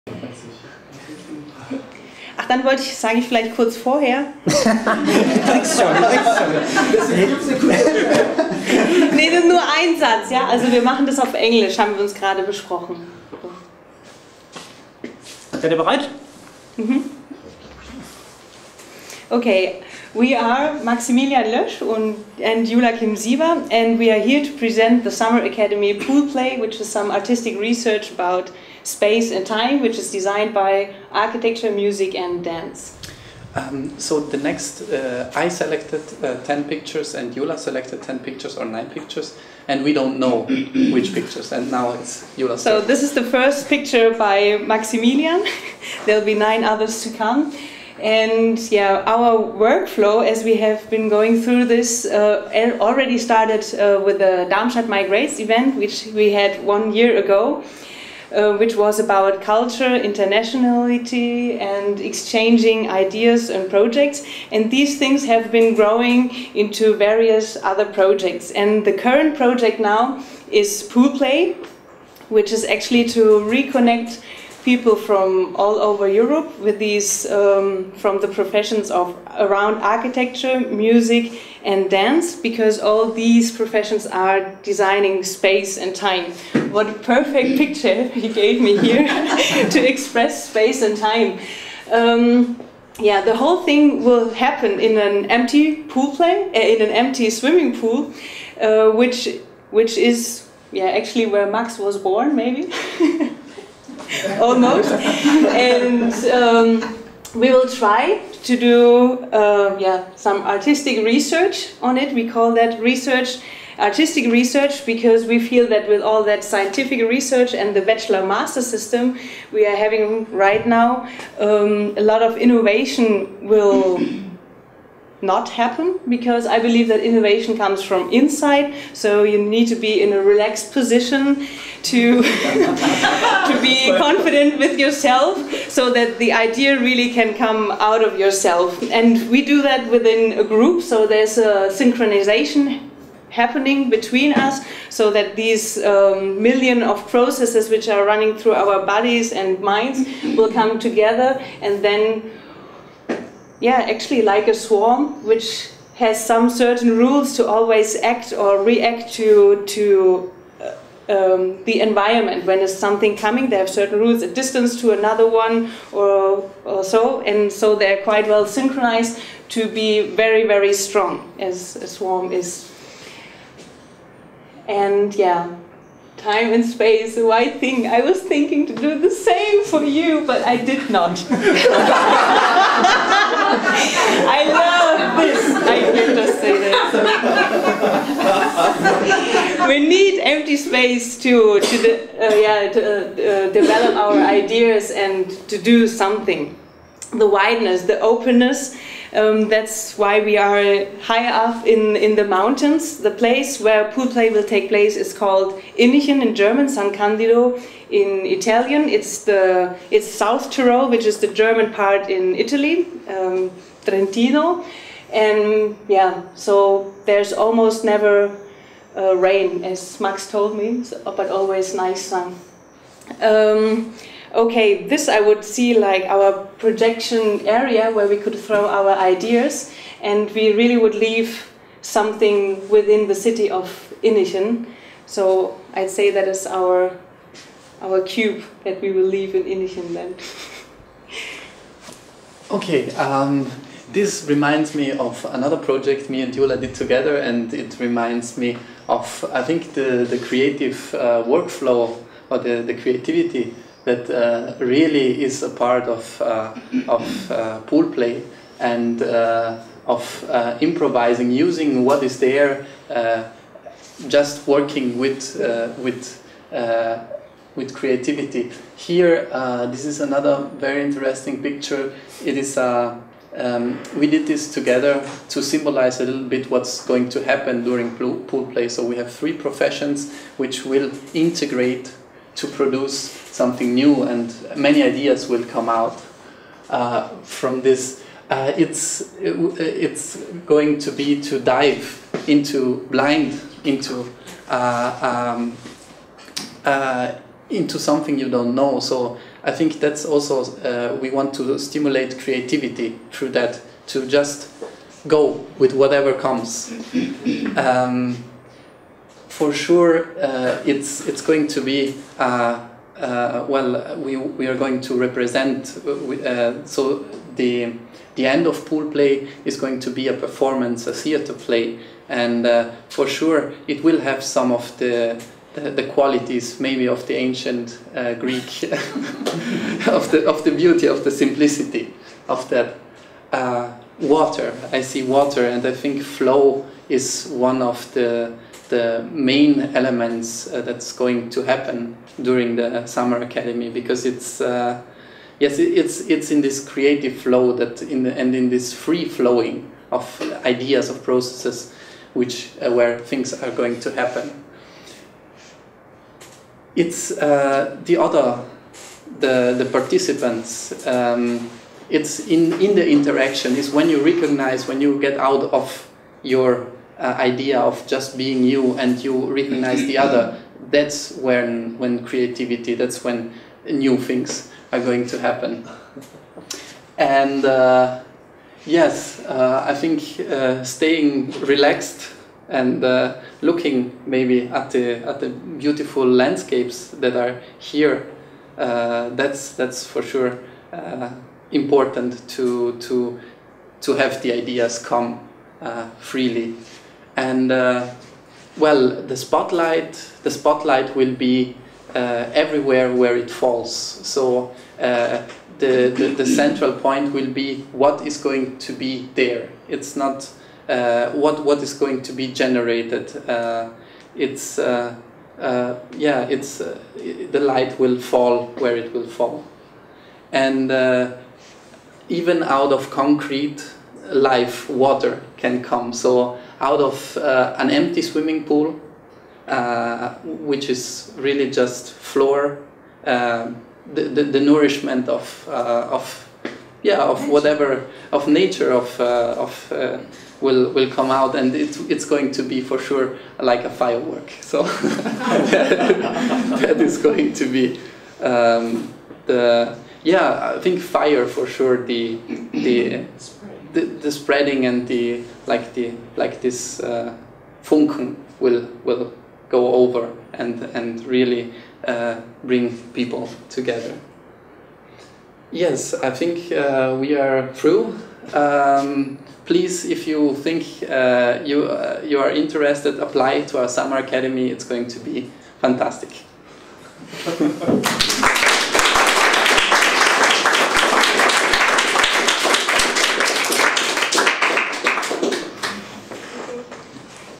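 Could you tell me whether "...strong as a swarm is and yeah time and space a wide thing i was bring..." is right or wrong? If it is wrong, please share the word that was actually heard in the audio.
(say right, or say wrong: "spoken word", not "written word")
wrong: "thinking", not "bring".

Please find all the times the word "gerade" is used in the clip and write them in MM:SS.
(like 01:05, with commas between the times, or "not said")
00:12.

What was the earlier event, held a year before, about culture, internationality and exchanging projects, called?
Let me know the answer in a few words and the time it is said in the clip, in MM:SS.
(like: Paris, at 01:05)
Darmstadt Migrates, at 00:54.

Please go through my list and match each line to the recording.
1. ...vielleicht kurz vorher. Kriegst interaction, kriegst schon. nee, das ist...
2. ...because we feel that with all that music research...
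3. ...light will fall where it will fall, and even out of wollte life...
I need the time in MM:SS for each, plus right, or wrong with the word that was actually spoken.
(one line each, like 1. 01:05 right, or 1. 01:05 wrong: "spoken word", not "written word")
1. 00:03 wrong: "schon", not "interaction"
2. 01:54 wrong: "scientific", not "music"
3. 06:57 wrong: "concrete", not "wollte".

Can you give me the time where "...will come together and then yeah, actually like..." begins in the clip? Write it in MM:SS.
02:30.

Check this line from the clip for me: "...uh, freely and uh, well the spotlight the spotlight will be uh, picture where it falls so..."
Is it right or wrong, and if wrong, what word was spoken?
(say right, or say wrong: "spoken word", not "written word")
wrong: "everywhere", not "picture".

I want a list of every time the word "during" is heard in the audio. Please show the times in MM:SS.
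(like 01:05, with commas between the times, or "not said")
04:37, 05:42.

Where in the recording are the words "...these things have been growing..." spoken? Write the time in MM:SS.
01:04.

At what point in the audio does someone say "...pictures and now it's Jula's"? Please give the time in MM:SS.
00:41.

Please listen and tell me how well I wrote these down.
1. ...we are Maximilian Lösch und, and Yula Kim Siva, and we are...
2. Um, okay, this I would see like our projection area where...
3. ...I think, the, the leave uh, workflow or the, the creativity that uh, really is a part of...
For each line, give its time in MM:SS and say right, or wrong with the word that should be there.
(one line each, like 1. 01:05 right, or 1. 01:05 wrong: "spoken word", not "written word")
1. 00:20 right
2. 03:43 right
3. 04:09 wrong: "creative", not "leave".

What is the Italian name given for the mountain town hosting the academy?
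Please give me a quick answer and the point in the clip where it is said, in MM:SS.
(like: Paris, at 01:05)
San Candido, at 03:26.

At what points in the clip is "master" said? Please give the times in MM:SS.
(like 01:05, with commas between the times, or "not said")
01:58.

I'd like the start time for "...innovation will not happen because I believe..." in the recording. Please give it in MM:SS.
02:02.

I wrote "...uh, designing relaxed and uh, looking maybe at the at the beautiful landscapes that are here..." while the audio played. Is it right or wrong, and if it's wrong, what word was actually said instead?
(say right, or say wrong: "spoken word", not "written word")
wrong: "staying", not "designing".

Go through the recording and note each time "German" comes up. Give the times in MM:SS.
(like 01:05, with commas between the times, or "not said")
03:26, 03:31.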